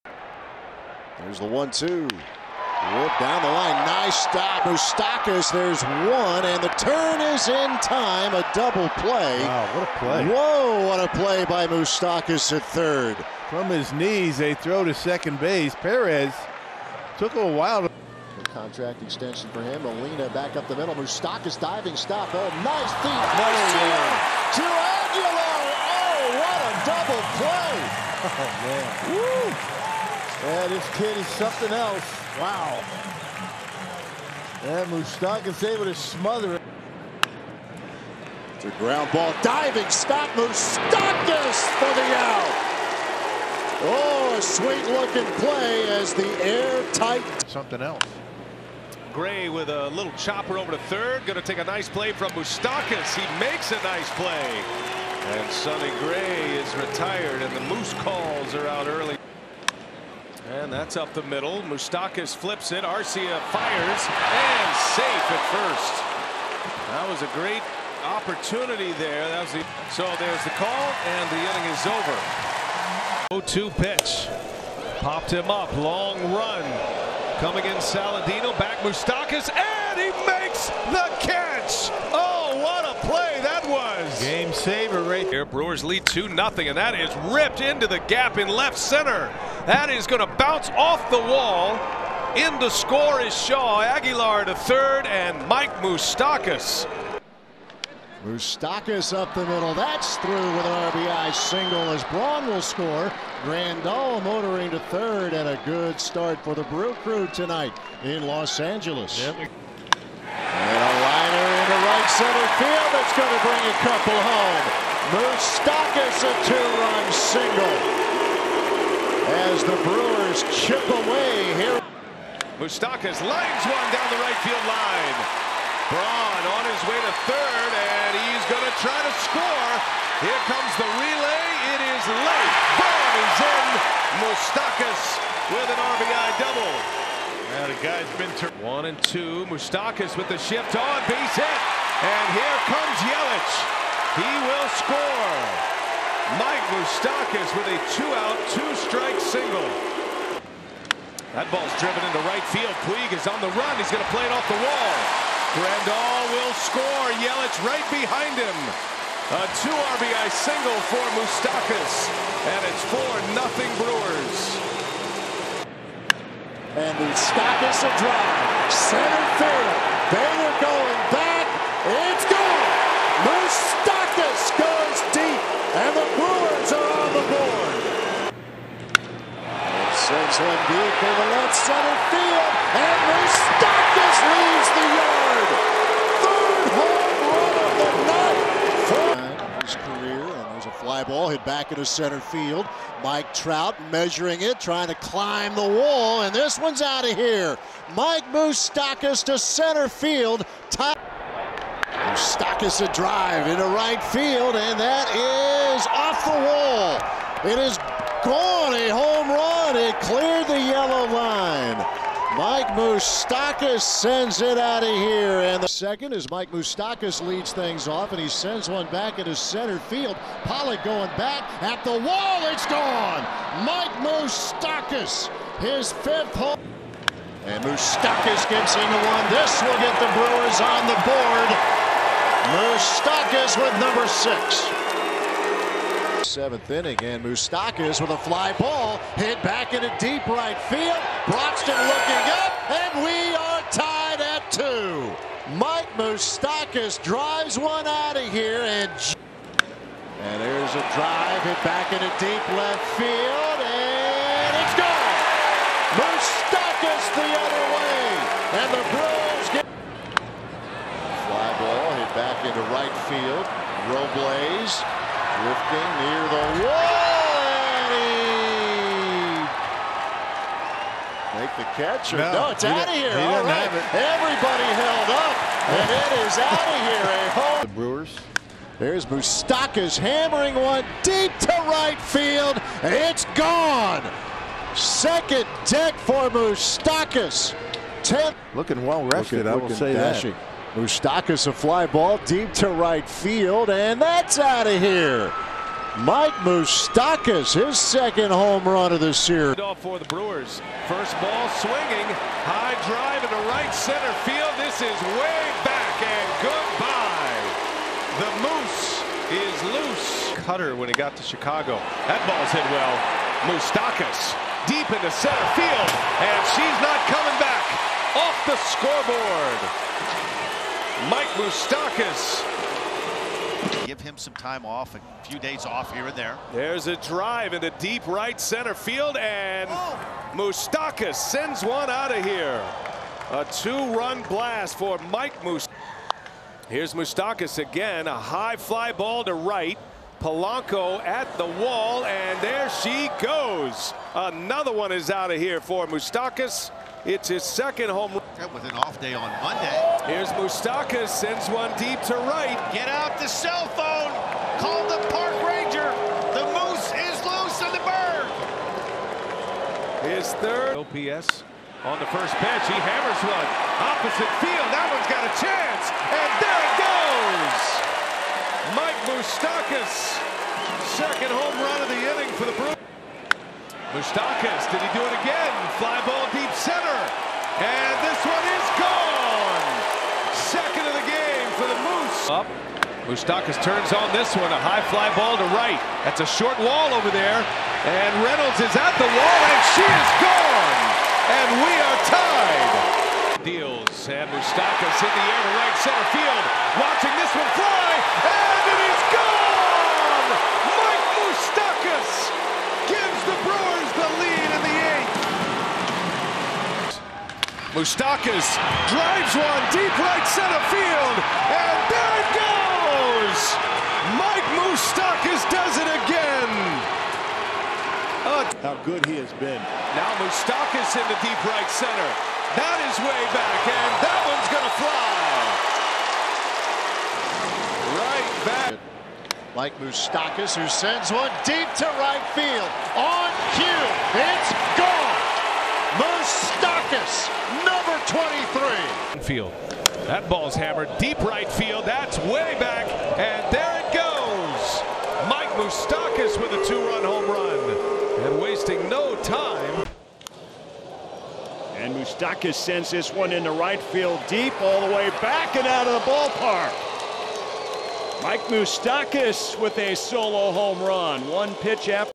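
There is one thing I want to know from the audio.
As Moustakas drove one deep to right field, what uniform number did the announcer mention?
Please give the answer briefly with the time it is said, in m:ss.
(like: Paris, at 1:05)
23, at 7:18.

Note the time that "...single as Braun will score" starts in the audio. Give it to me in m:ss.
1:41.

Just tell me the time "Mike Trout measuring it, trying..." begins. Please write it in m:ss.
3:13.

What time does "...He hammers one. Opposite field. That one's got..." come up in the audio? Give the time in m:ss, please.
6:02.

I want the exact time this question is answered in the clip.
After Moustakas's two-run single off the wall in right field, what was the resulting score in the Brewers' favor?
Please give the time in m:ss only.
2:42.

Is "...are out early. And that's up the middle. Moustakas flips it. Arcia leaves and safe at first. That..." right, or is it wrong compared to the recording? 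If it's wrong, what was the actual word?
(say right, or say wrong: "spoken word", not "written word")
wrong: "fires", not "leaves".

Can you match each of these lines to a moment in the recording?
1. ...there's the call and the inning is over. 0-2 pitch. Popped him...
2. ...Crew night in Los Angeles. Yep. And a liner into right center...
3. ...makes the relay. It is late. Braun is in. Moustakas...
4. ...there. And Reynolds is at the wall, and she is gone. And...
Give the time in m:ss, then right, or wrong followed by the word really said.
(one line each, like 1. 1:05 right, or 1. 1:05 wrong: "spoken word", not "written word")
1. 1:10 right
2. 1:47 wrong: "tonight", not "night"
3. 2:10 wrong: "comes", not "makes"
4. 6:27 right.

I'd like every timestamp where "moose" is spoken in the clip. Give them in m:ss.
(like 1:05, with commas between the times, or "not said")
0:57, 5:08, 5:56, 6:21.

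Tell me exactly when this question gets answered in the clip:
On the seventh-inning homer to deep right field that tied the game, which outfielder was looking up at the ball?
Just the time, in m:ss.
4:01.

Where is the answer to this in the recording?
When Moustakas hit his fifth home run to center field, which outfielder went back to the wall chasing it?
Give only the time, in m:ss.
3:40.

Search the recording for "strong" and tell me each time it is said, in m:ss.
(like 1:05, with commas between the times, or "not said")
not said.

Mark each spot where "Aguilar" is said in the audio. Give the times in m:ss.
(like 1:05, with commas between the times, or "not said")
0:24, 1:33.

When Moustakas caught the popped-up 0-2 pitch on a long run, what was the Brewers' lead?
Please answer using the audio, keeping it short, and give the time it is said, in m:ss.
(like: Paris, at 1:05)
2-0, at 1:26.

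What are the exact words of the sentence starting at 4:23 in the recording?
Robles Drifting near the wall, Make the catch, or no, no it's out of here.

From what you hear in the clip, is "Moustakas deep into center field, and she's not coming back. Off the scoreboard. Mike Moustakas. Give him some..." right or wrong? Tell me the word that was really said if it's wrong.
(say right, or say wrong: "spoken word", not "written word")
right.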